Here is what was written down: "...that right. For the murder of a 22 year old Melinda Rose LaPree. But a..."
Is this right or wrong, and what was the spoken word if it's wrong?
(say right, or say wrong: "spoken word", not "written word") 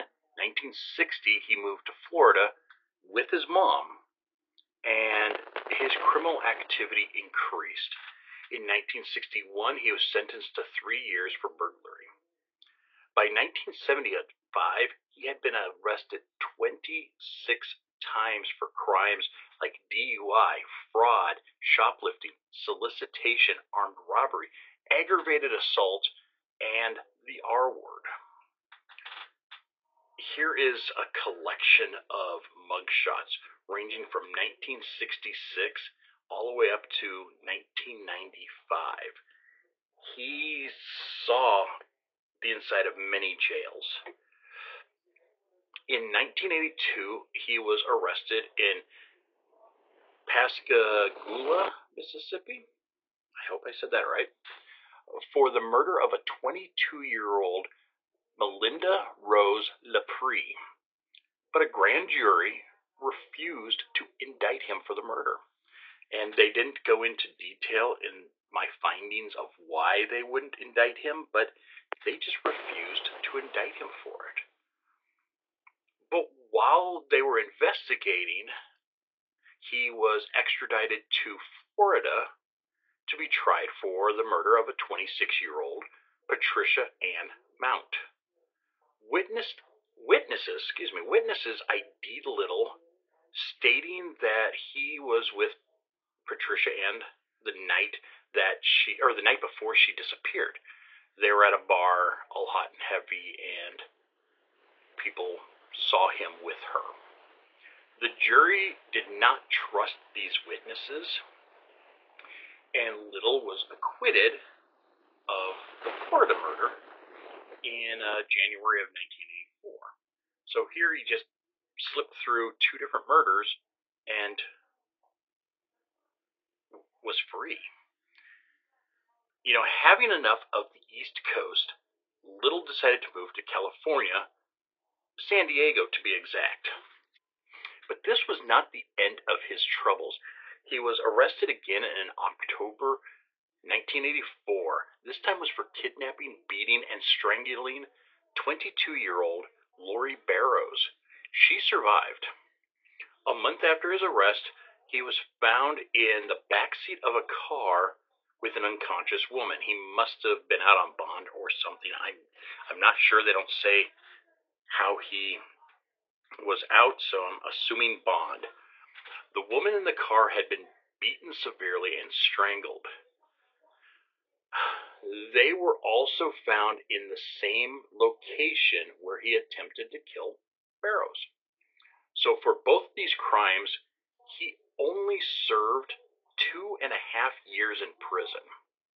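right.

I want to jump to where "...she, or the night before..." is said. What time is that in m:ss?
1:38.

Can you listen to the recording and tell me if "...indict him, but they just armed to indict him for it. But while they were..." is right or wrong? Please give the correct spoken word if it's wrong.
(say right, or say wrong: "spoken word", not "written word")
wrong: "refused", not "armed".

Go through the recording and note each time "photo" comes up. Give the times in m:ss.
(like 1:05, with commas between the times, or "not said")
not said.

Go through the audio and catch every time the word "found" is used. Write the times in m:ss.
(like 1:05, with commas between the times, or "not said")
2:35, 2:56.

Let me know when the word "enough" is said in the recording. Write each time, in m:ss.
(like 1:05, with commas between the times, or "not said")
2:10.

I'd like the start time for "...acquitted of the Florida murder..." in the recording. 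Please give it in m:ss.
1:53.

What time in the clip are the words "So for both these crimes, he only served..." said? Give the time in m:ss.
3:02.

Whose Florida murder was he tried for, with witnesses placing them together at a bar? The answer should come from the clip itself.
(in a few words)
Patricia Ann Mount.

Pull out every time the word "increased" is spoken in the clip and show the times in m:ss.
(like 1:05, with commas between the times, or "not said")
0:07.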